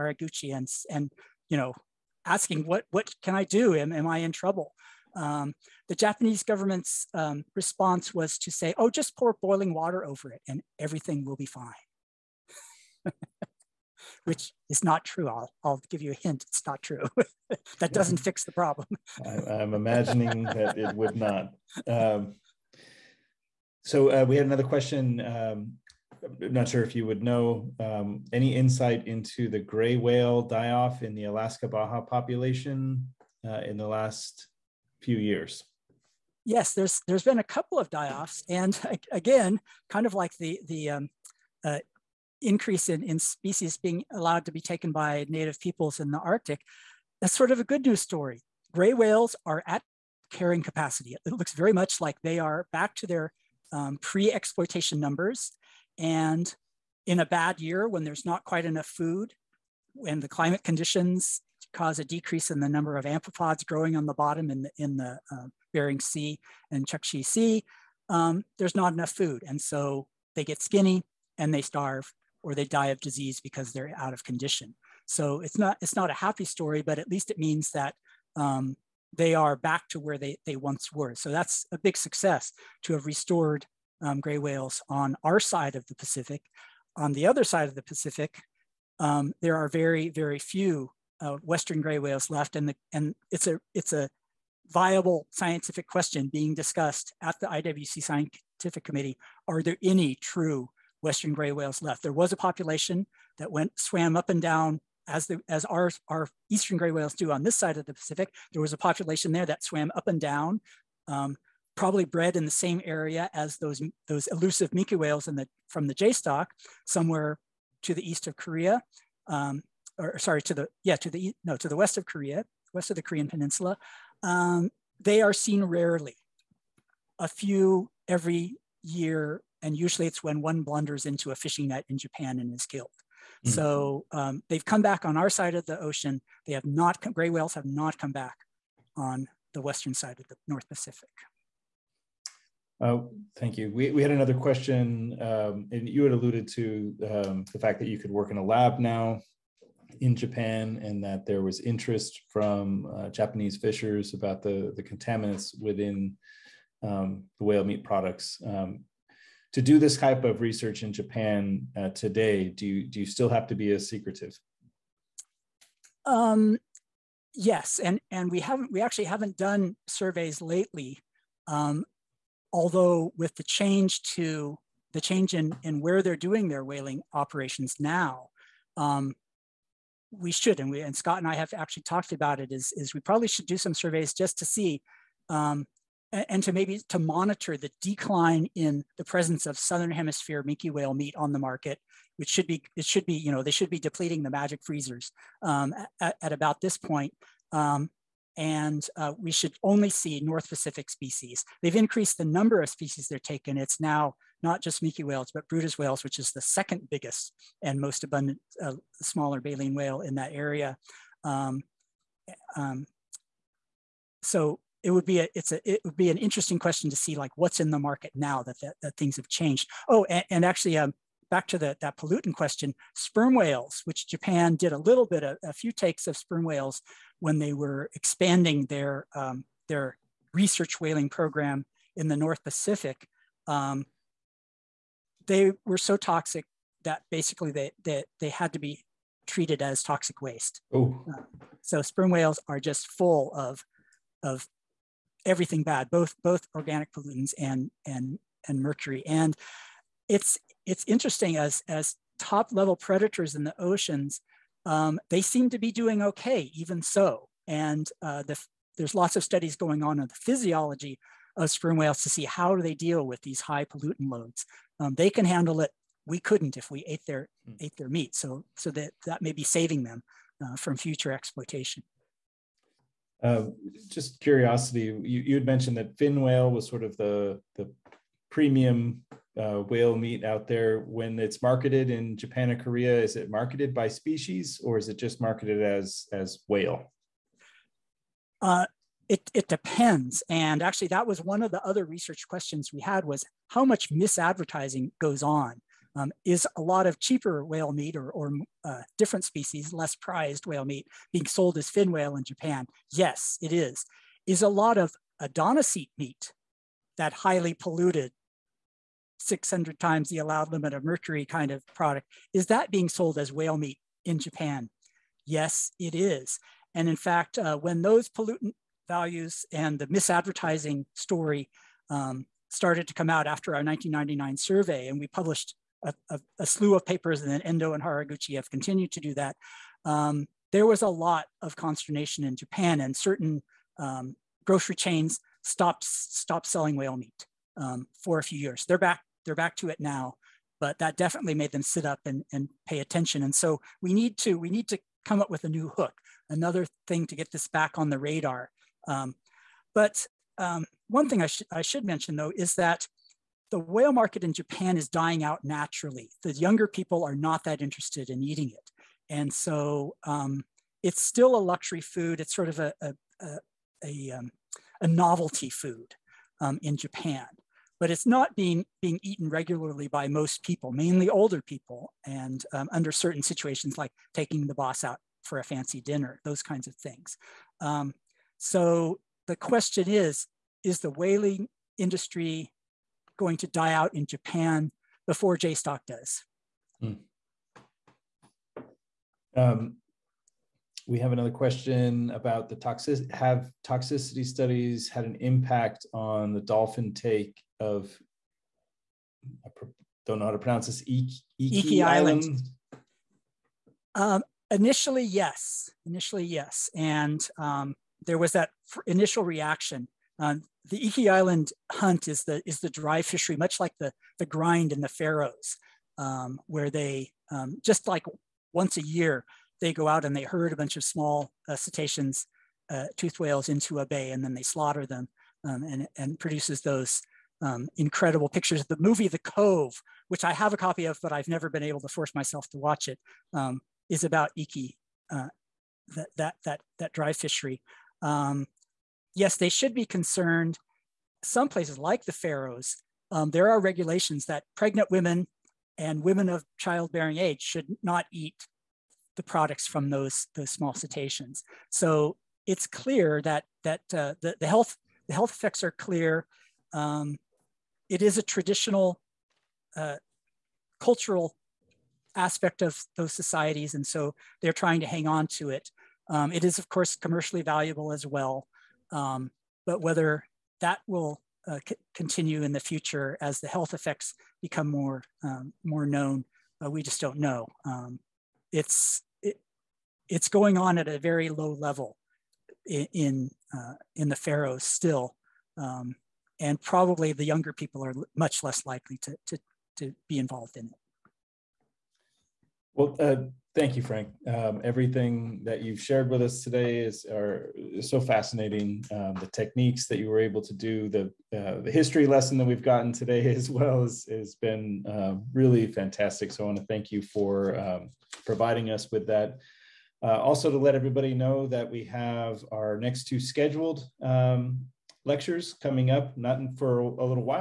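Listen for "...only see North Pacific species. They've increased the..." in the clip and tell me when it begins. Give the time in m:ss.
3:19.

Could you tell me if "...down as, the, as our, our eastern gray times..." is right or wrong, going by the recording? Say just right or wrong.
wrong.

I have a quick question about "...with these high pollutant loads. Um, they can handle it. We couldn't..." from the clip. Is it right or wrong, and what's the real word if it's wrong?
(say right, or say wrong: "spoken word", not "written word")
right.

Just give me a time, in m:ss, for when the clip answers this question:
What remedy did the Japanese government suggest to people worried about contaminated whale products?
0:09.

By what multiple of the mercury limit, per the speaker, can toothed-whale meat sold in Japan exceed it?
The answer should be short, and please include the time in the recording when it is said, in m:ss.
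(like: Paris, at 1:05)
600, at 5:09.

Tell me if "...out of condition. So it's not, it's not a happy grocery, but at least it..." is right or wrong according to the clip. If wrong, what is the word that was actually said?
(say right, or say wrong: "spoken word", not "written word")
wrong: "story", not "grocery".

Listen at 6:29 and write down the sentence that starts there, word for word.
Um, we have another question about the toxic.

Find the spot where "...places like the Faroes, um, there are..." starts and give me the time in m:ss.
7:21.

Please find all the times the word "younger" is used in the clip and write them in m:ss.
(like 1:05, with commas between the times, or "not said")
5:56, 8:07.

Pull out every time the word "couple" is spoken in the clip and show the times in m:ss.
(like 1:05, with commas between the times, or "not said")
0:37.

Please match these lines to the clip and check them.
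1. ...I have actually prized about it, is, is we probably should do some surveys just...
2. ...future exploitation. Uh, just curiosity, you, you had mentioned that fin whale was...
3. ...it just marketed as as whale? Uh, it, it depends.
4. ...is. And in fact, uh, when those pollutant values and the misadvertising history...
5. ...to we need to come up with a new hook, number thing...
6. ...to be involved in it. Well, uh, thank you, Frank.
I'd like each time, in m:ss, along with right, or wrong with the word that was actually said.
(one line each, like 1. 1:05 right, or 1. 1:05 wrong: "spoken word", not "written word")
1. 3:01 wrong: "talked", not "prized"
2. 4:30 right
3. 4:44 right
4. 5:15 wrong: "story", not "history"
5. 5:44 wrong: "another", not "number"
6. 8:09 right.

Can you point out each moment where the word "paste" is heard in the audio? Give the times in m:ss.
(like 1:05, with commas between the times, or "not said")
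not said.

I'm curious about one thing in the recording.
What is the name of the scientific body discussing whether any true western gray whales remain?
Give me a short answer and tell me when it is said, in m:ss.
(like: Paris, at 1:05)
IWC Scientific Committee, at 1:37.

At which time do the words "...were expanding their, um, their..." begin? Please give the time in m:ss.
3:47.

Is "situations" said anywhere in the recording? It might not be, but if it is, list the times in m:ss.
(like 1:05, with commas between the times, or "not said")
6:13.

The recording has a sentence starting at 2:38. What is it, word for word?
Um, to do this type of research in Japan uh, today, do you, do you still have to be as secretive?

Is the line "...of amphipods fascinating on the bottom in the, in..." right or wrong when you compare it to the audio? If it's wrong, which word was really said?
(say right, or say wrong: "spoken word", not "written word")
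wrong: "growing", not "fascinating".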